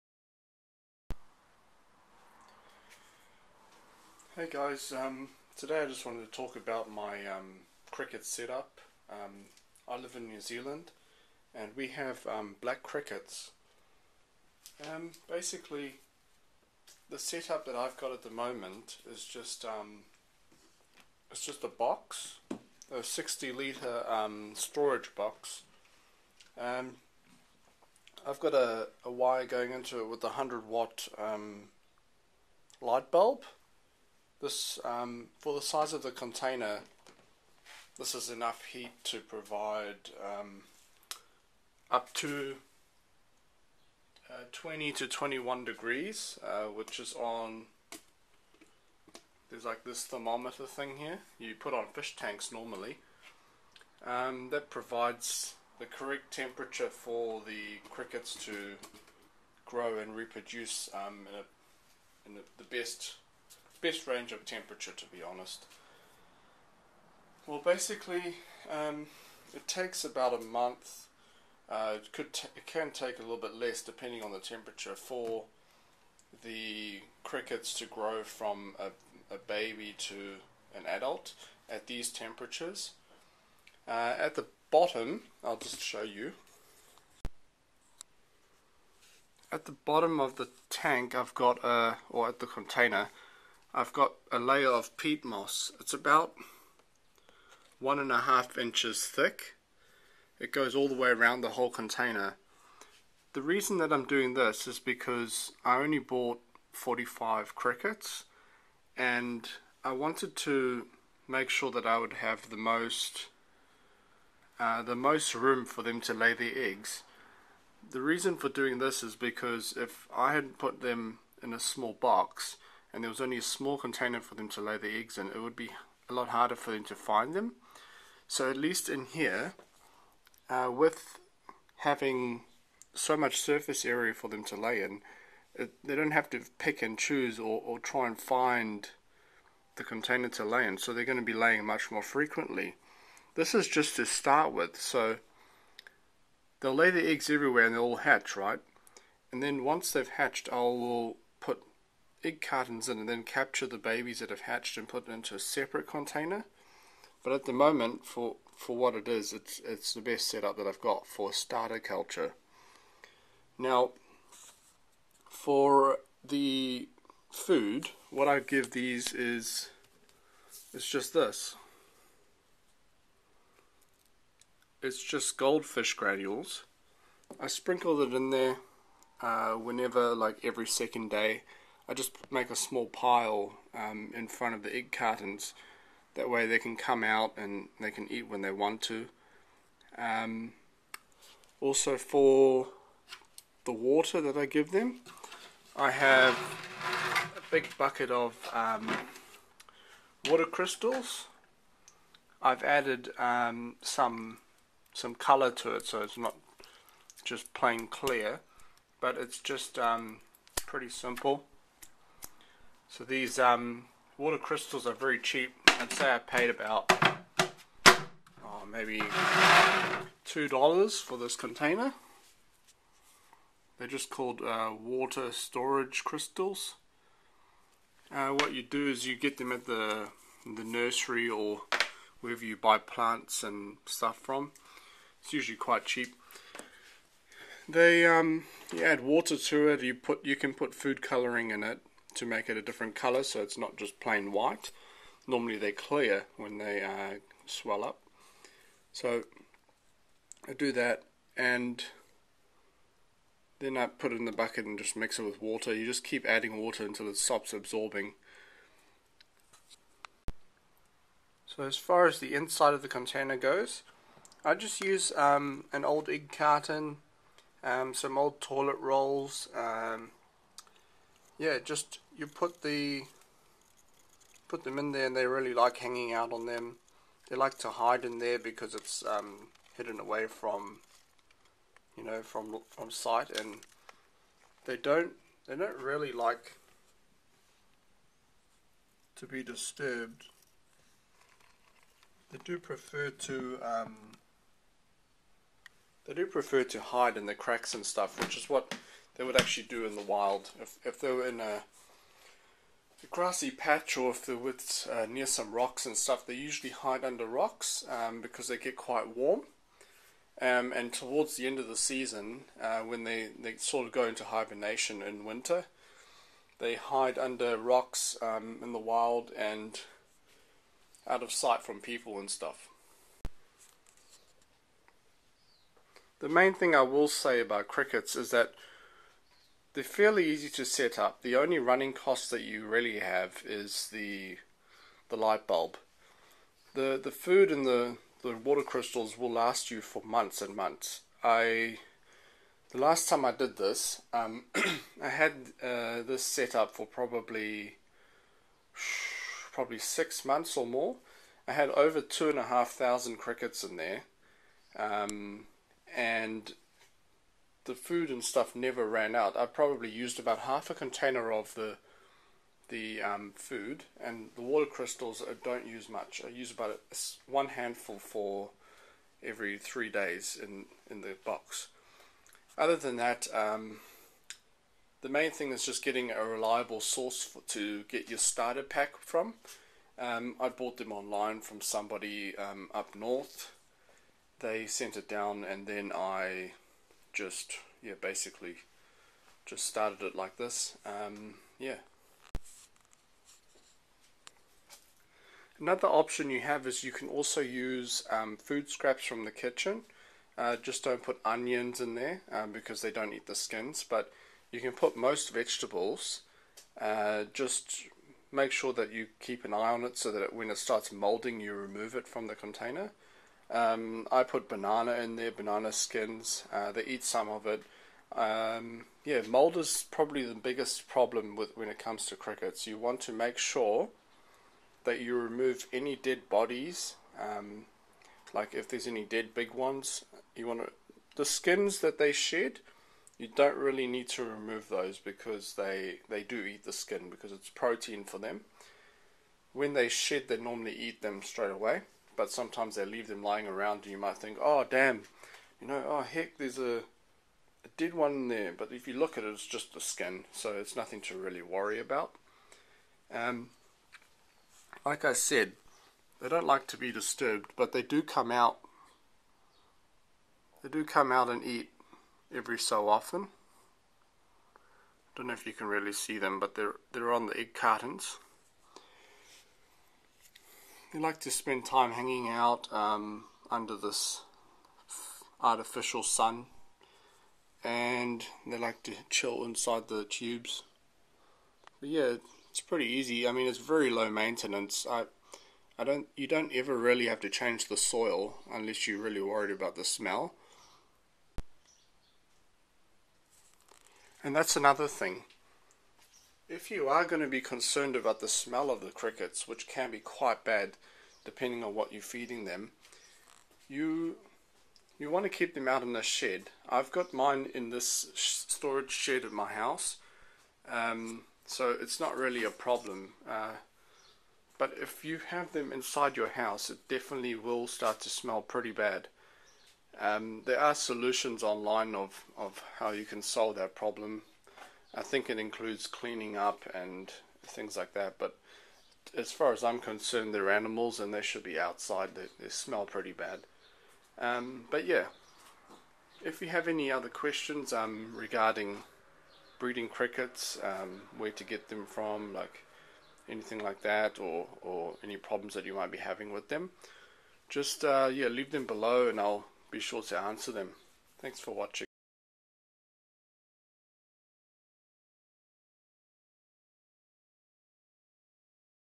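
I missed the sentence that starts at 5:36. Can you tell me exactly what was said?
The the food and the, the water crystals will last you for months and months.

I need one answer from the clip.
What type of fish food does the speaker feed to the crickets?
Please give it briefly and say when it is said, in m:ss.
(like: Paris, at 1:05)
goldfish granules, at 2:55.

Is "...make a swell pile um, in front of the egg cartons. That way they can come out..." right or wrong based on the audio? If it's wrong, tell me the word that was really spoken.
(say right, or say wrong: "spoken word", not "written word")
wrong: "small", not "swell".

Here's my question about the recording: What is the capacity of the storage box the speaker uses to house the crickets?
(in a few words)
60 litres.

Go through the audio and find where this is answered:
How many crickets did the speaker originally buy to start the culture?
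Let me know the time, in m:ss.
1:46.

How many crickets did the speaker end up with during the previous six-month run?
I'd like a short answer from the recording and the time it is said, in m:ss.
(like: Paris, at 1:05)
over 2,500, at 5:52.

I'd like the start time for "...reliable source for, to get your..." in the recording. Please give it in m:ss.
6:16.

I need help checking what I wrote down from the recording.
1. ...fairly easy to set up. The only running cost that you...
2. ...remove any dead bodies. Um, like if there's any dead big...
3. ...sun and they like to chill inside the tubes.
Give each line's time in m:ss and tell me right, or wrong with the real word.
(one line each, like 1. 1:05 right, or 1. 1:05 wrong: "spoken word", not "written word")
1. 5:29 right
2. 7:05 right
3. 7:56 right.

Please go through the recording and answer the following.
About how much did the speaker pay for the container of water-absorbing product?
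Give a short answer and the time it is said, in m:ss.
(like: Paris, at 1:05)
$2, at 3:40.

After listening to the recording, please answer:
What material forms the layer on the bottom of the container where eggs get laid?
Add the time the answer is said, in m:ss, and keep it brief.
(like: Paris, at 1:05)
peat moss, at 1:34.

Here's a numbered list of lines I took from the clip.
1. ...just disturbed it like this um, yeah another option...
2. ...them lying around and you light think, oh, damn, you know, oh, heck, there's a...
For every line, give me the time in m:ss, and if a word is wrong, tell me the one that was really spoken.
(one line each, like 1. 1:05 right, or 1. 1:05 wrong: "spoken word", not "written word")
1. 6:29 wrong: "started", not "disturbed"
2. 7:23 wrong: "might", not "light".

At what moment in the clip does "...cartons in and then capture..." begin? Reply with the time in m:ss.
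2:32.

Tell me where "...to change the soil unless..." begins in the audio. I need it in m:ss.
8:07.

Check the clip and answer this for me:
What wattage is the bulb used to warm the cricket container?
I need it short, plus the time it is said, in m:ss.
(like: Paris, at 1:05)
100 watts, at 0:30.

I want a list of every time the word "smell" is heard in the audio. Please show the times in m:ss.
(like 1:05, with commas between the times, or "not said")
8:09, 8:18, 8:38, 8:52.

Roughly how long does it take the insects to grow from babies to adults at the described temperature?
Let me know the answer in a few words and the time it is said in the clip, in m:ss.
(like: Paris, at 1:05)
about a month, at 1:10.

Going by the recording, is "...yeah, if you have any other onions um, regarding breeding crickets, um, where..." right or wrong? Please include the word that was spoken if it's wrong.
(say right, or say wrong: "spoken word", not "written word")
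wrong: "questions", not "onions".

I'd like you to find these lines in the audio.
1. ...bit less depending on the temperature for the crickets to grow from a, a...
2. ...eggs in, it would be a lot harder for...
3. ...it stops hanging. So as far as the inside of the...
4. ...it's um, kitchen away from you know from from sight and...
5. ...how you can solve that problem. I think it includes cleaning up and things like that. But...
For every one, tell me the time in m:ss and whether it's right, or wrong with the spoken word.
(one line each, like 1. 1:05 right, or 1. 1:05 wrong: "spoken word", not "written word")
1. 1:13 right
2. 2:04 right
3. 4:17 wrong: "absorbing", not "hanging"
4. 4:38 wrong: "hidden", not "kitchen"
5. 8:42 right.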